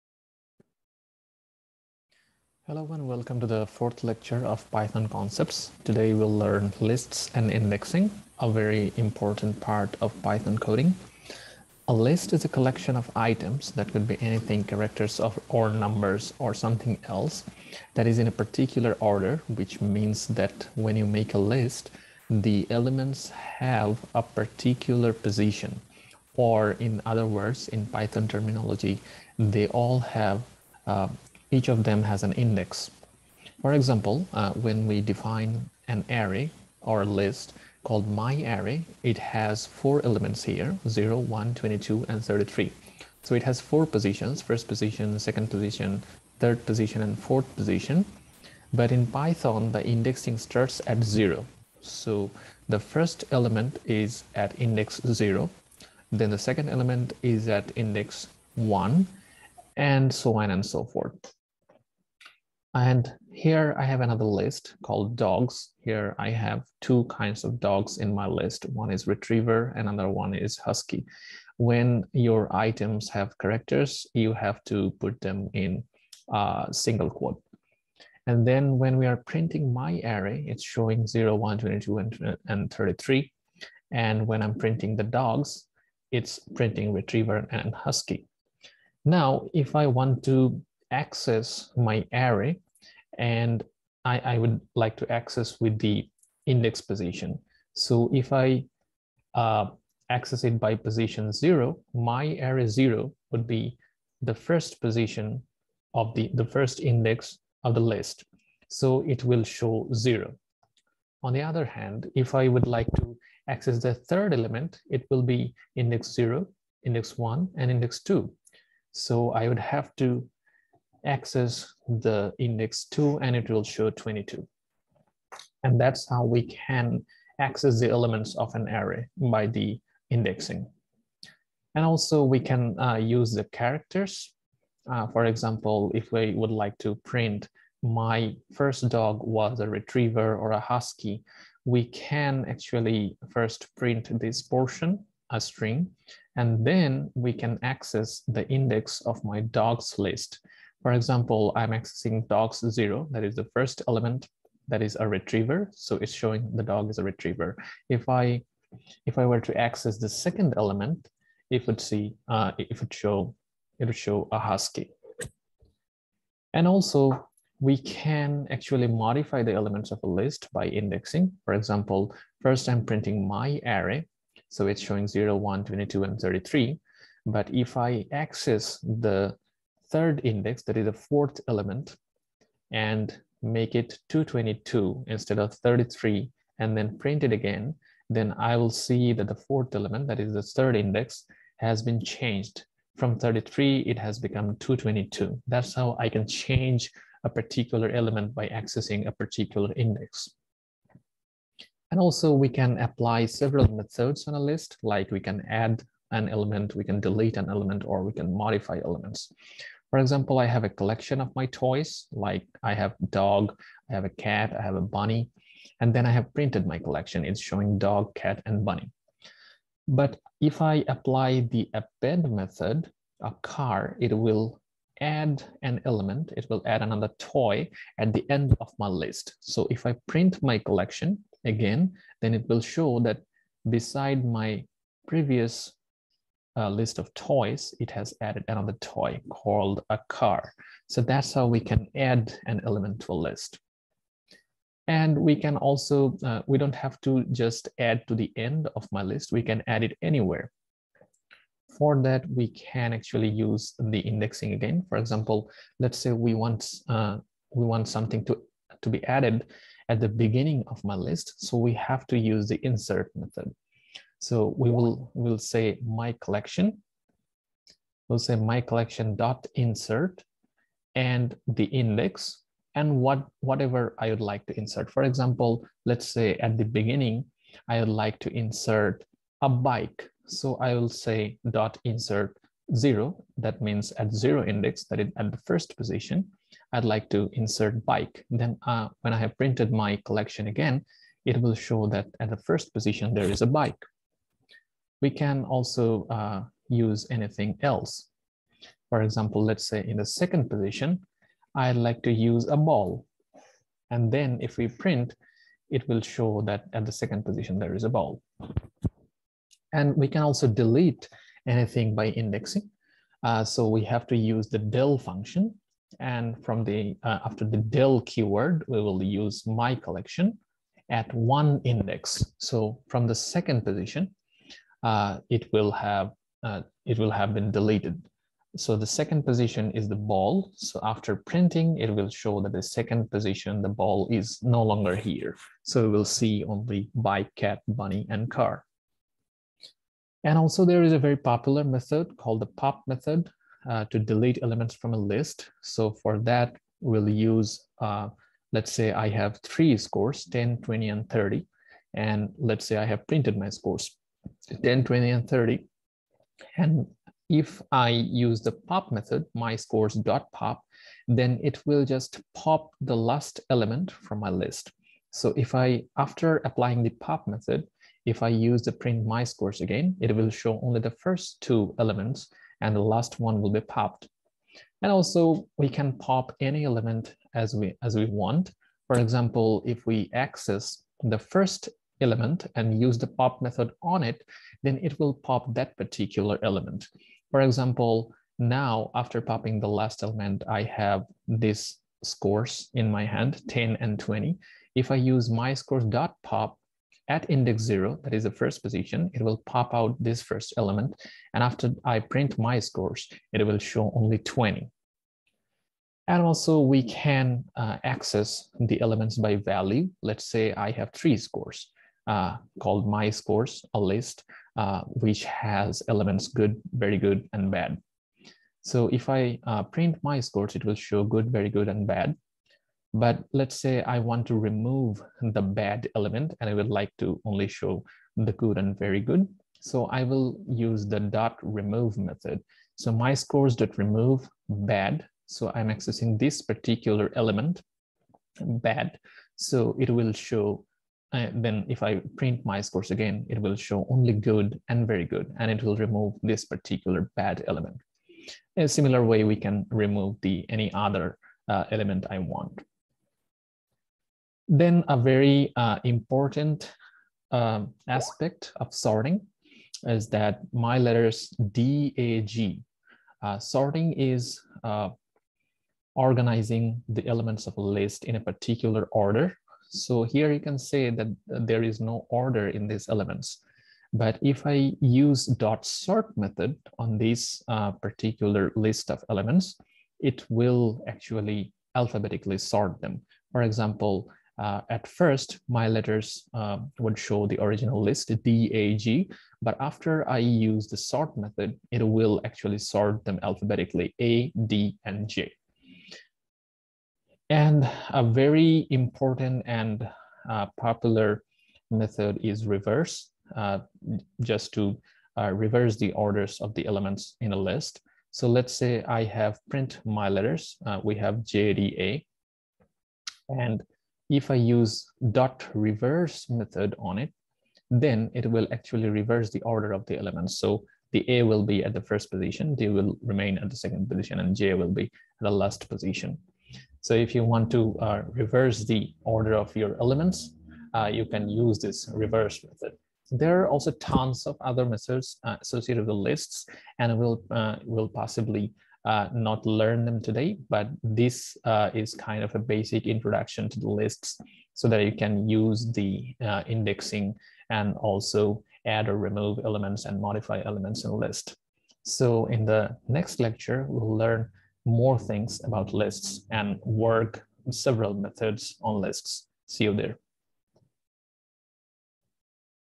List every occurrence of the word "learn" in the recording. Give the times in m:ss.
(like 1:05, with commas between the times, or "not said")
0:06, 8:59, 9:13.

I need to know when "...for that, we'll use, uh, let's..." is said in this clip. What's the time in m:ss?
5:46.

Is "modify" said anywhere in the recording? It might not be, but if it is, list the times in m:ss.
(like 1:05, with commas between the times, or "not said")
2:48, 3:28, 9:10.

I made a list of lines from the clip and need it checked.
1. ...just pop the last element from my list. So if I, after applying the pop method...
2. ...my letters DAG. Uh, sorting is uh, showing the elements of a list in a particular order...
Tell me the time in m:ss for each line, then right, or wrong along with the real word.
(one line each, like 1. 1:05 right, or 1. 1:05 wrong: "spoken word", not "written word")
1. 6:01 right
2. 7:40 wrong: "organizing", not "showing".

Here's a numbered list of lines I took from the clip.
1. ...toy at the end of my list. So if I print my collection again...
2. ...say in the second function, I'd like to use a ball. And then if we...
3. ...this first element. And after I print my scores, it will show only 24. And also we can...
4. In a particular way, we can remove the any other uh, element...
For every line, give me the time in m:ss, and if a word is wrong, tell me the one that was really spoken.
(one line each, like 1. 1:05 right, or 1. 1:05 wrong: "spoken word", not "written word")
1. 3:47 right
2. 4:59 wrong: "position", not "function"
3. 6:39 wrong: "20", not "24"
4. 7:28 wrong: "similar", not "particular".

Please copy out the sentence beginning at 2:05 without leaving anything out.
And that's how we can access the elements of an array by the indexing.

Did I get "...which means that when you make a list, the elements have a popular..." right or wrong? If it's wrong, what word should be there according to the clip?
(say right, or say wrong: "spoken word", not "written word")
wrong: "particular", not "popular".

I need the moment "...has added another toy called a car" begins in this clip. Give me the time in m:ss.
3:57.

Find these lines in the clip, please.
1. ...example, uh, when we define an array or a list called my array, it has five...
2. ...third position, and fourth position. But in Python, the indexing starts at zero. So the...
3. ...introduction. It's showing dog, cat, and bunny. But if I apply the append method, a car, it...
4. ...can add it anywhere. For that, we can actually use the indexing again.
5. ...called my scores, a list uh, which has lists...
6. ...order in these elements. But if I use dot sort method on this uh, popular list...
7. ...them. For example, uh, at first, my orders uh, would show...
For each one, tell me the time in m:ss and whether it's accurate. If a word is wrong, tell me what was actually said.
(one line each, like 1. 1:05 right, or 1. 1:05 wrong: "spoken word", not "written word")
1. 0:33 wrong: "four", not "five"
2. 0:46 right
3. 3:36 wrong: "collection", not "introduction"
4. 4:09 right
5. 6:52 wrong: "elements", not "lists"
6. 7:52 wrong: "particular", not "popular"
7. 8:02 wrong: "letters", not "orders".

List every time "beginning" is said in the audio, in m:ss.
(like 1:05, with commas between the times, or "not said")
4:20, 4:36.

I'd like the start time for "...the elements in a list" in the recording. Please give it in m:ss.
8:26.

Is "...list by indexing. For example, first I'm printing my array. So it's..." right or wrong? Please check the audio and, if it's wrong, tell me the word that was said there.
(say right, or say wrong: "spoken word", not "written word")
right.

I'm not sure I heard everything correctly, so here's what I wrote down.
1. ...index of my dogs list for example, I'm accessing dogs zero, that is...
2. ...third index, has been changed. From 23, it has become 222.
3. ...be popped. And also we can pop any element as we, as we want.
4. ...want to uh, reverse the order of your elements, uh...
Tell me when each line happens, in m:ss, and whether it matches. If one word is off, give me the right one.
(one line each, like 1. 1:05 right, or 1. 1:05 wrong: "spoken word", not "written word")
1. 2:28 right
2. 3:10 wrong: "33", not "23"
3. 6:13 right
4. 8:47 right.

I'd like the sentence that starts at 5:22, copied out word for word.
So from the second position, uh, it will have uh, it will have been deleted.